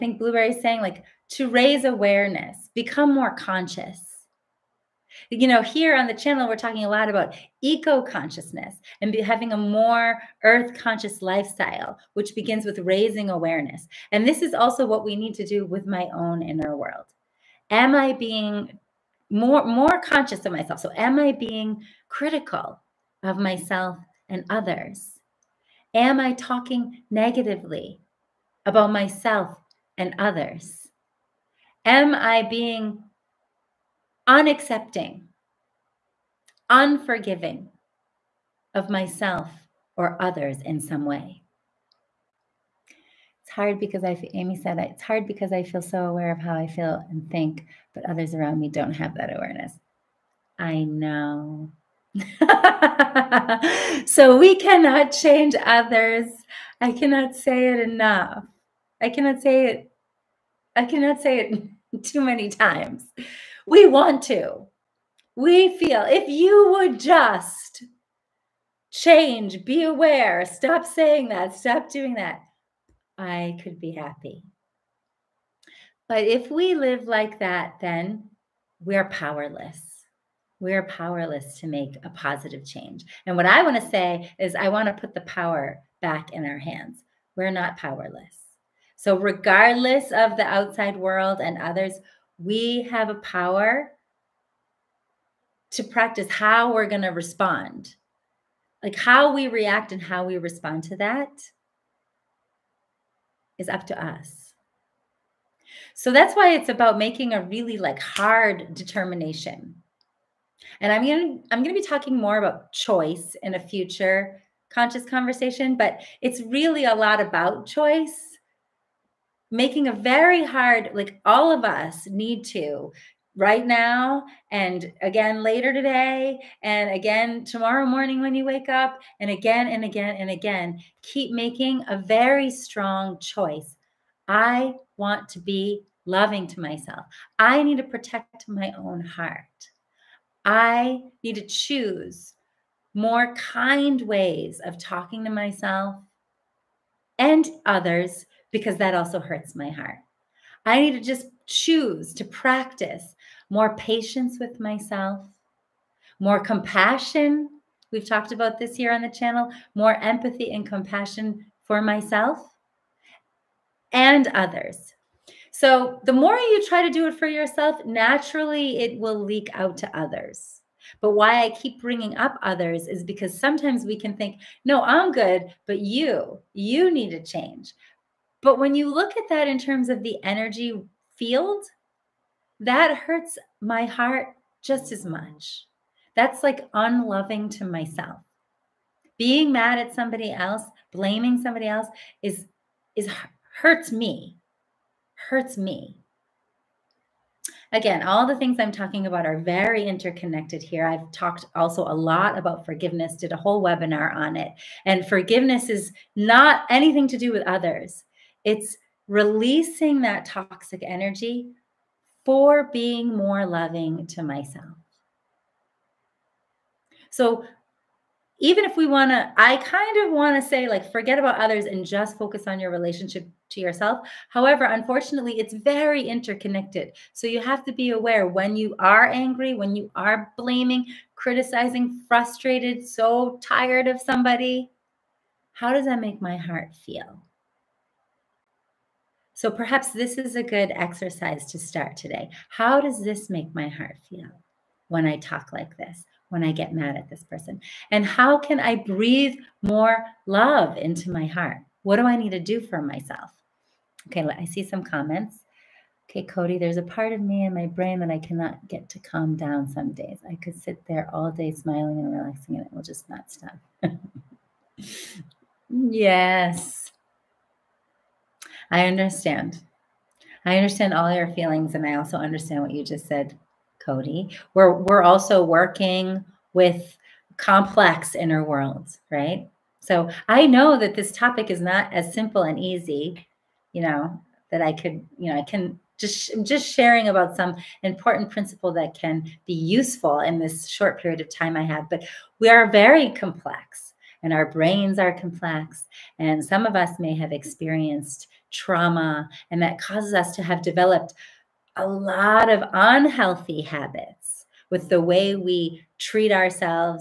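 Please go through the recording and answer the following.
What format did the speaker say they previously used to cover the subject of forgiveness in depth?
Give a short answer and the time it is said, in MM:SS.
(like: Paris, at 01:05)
webinar, at 03:23.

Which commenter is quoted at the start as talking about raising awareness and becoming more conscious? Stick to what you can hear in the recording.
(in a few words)
Blueberry.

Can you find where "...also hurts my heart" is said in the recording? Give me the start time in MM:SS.
02:28.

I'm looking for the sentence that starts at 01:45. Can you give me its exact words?
So that's why it's about making a really like hard determination.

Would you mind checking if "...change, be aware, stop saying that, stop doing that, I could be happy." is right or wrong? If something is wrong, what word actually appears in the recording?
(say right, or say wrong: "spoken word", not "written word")
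right.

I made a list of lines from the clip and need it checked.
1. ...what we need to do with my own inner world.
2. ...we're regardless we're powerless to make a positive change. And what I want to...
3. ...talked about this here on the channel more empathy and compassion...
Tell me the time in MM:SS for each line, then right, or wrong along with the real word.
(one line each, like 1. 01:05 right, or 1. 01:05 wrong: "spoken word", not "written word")
1. 00:14 right
2. 01:18 wrong: "powerless", not "regardless"
3. 02:38 right.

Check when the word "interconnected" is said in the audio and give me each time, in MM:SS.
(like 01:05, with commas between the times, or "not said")
03:19, 03:46.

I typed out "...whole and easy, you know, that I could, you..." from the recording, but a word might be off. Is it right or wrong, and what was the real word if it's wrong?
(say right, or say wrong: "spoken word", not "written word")
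wrong: "simple", not "whole".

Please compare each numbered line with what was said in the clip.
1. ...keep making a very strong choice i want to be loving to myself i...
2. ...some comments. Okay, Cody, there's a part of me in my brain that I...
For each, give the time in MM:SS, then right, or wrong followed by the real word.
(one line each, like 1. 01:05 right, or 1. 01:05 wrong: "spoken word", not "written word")
1. 02:11 right
2. 04:14 right.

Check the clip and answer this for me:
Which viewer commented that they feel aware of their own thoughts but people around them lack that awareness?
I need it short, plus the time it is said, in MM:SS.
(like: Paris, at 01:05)
Amy, at 00:44.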